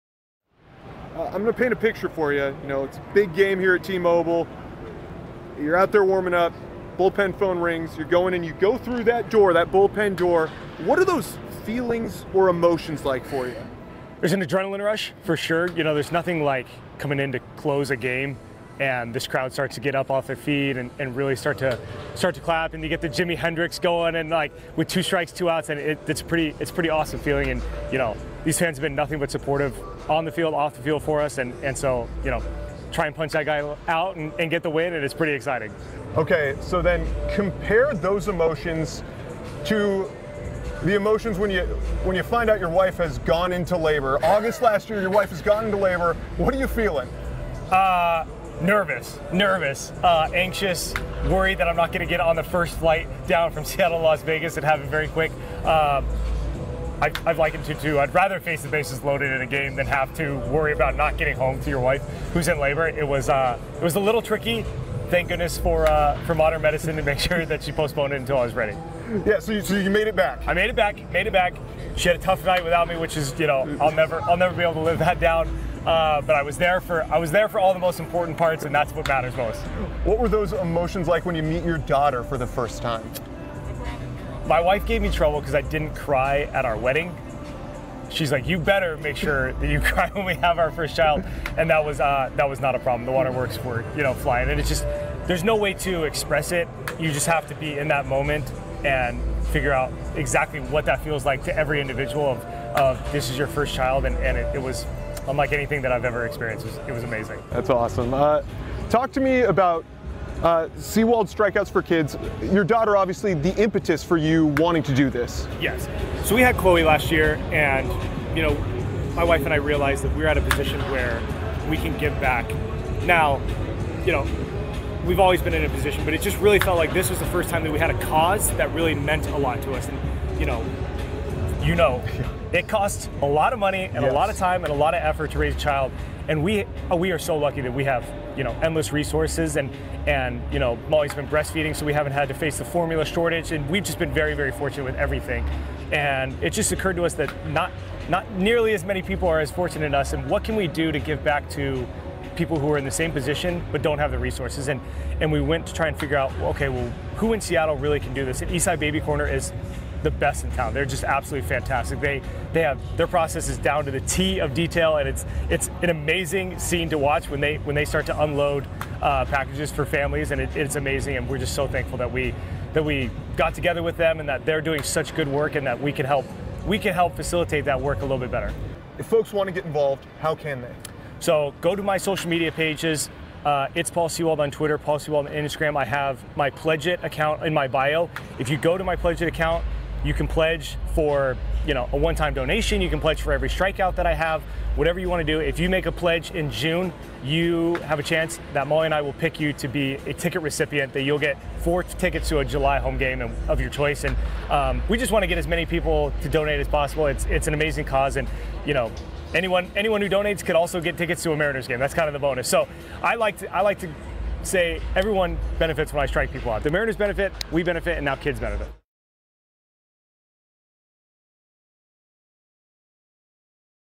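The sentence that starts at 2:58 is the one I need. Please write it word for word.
If folks want to get involved, how can they?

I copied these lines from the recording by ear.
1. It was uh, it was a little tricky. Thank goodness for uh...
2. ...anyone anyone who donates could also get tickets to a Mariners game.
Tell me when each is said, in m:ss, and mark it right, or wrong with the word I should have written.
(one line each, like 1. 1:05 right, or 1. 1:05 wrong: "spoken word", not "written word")
1. 1:02 right
2. 3:29 right.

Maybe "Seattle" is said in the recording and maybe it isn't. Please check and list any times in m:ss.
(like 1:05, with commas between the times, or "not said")
0:53, 2:37.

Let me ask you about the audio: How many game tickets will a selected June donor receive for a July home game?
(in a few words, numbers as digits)
4.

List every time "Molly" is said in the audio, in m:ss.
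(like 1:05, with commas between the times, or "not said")
2:20, 3:18.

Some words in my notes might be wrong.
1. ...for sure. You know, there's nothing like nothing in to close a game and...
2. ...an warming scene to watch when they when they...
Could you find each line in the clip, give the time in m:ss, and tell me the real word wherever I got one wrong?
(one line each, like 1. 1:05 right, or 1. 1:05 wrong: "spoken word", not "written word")
1. 0:15 wrong: "coming", not "nothing"
2. 2:45 wrong: "amazing", not "warming".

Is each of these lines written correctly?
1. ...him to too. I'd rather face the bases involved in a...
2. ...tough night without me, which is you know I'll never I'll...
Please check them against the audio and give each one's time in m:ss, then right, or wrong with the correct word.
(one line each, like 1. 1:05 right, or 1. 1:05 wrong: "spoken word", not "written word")
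1. 0:57 wrong: "loaded", not "involved"
2. 1:12 right.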